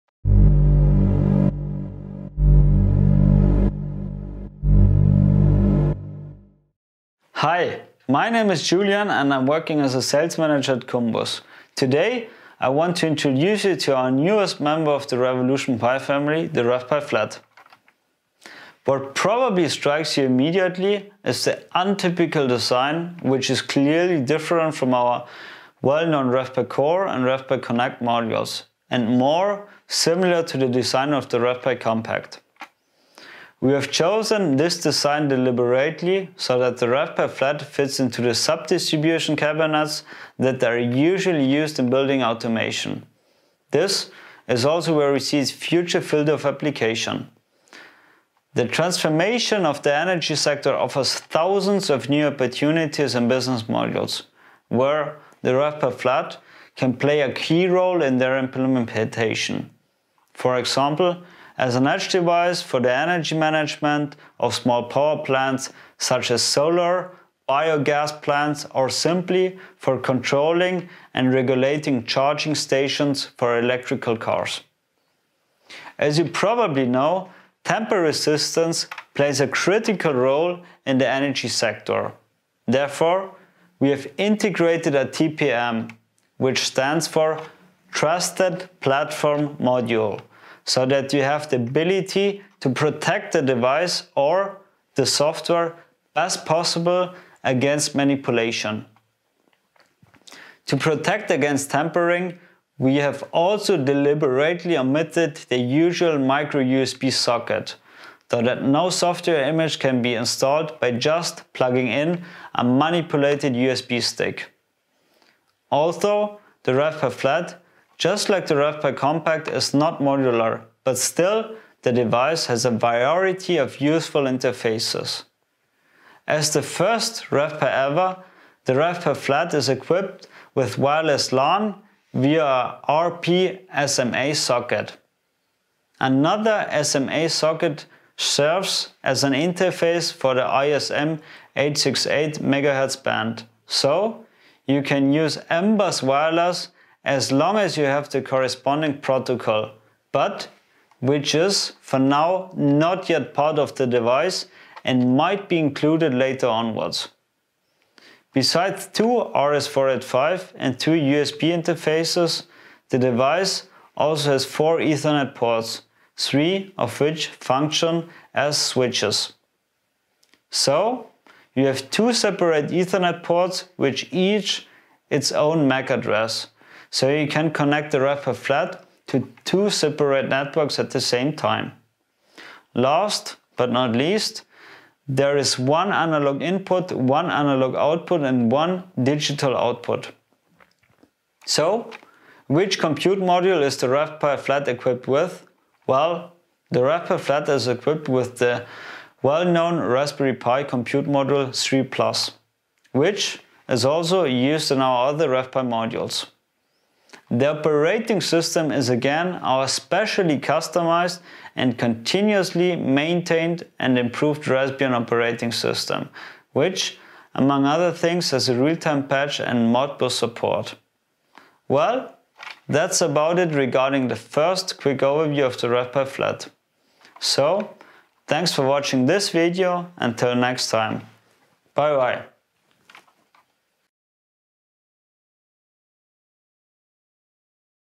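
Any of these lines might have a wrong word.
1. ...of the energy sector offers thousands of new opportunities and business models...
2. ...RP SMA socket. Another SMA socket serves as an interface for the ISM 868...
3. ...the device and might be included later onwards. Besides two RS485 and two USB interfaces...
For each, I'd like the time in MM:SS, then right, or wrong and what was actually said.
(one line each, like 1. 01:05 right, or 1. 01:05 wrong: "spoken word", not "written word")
1. 00:49 right
2. 02:12 right
3. 02:33 right.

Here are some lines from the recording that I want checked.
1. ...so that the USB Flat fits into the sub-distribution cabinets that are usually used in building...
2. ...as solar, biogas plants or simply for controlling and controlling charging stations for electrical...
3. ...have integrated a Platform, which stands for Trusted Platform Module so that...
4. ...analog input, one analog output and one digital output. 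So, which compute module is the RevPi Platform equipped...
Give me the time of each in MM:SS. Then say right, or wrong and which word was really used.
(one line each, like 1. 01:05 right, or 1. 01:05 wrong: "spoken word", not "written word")
1. 00:36 wrong: "RevPi", not "USB"
2. 01:06 wrong: "regulating", not "controlling"
3. 01:23 wrong: "TPM", not "Platform"
4. 03:05 wrong: "Flat", not "Platform".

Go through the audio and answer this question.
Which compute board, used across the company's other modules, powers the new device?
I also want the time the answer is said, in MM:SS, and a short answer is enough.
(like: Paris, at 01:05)
Raspberry Pi Compute Module 3 Plus, at 03:19.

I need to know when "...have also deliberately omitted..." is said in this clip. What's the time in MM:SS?
01:42.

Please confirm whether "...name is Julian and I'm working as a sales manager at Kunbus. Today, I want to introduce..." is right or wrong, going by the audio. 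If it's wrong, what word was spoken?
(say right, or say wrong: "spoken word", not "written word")
right.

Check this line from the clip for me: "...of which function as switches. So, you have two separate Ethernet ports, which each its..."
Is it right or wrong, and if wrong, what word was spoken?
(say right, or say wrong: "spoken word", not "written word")
right.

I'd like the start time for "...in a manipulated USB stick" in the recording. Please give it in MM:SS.
01:51.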